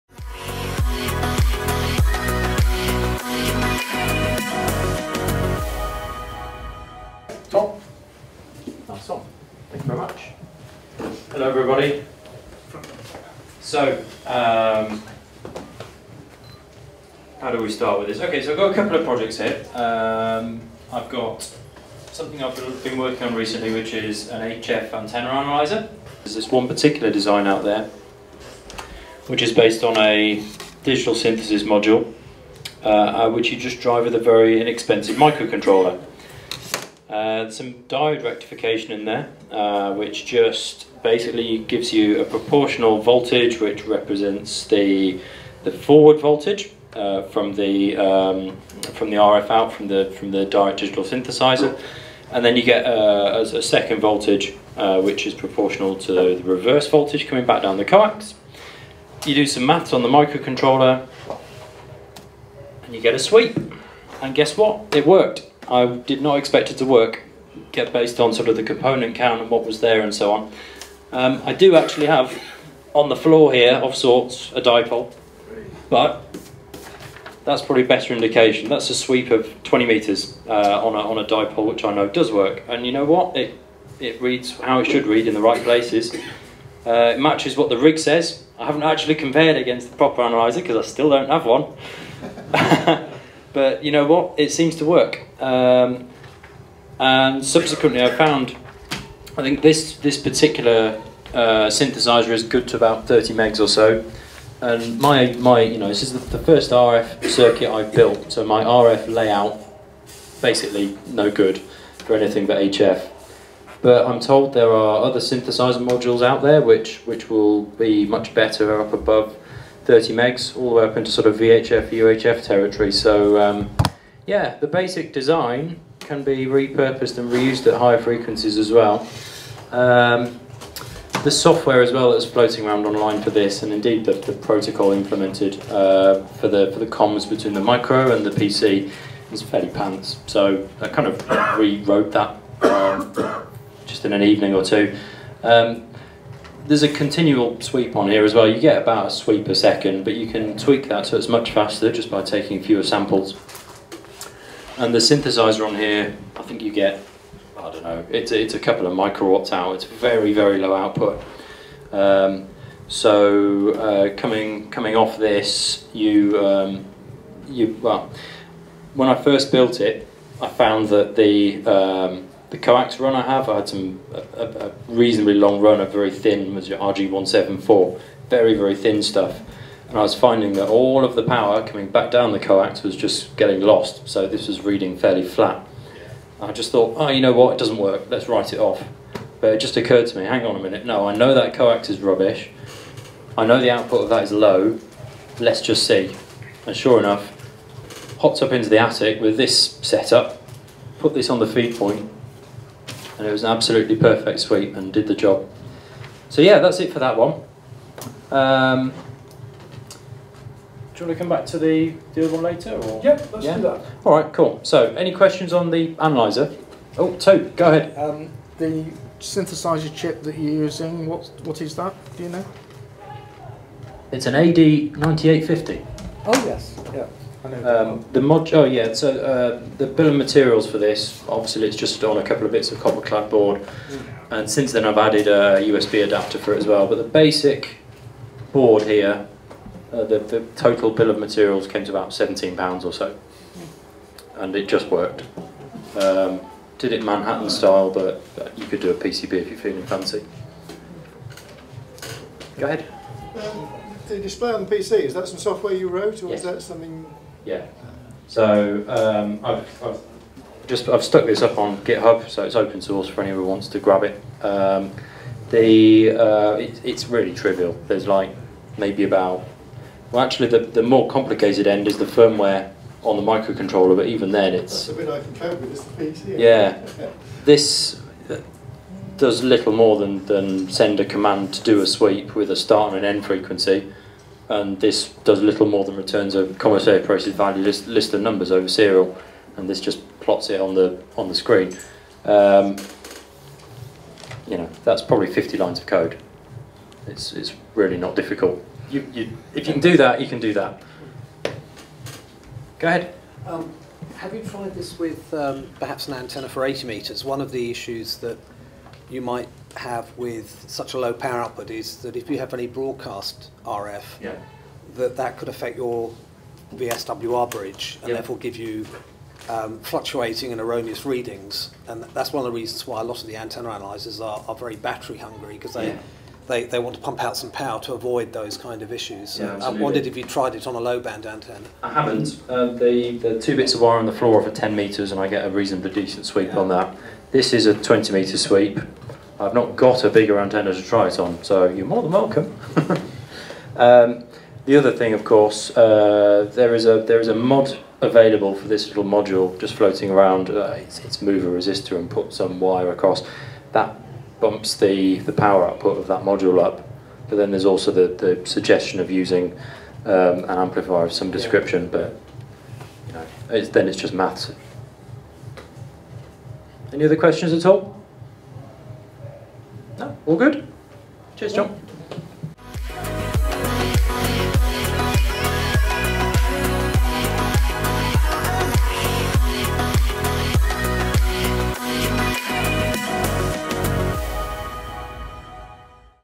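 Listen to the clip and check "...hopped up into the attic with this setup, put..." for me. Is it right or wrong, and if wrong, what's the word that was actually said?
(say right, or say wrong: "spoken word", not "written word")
right.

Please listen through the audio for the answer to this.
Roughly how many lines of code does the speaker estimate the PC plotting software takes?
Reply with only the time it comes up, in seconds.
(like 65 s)
295 s.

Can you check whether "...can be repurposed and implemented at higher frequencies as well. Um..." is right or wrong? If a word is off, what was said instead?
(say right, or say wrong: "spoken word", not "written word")
wrong: "reused", not "implemented".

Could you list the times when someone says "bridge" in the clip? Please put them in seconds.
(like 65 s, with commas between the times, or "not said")
317 s.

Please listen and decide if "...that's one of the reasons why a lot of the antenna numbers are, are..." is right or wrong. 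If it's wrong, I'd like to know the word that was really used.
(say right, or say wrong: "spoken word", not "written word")
wrong: "analyzers", not "numbers".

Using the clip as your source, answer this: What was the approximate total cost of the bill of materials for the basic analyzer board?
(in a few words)
£17.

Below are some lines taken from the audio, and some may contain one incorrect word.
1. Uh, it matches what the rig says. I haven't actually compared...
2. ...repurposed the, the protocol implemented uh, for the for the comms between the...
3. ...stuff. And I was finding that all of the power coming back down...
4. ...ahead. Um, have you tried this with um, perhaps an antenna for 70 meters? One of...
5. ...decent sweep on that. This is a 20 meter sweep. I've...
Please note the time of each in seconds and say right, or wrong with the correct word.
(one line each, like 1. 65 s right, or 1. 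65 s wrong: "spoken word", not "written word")
1. 86 s right
2. 133 s wrong: "indeed", not "repurposed"
3. 179 s right
4. 302 s wrong: "80", not "70"
5. 335 s right.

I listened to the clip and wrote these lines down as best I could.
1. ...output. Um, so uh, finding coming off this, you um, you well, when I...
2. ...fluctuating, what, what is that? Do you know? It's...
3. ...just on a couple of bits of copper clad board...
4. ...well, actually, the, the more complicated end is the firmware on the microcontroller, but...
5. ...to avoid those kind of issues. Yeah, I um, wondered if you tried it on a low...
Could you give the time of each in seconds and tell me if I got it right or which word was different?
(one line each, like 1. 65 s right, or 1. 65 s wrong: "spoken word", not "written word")
1. 160 s wrong: "coming", not "finding"
2. 220 s wrong: "using", not "fluctuating"
3. 231 s right
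4. 270 s right
5. 327 s right.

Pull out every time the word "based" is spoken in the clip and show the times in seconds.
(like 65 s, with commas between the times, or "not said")
29 s, 67 s.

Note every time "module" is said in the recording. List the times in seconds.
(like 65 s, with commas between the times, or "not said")
31 s, 115 s, 349 s, 356 s.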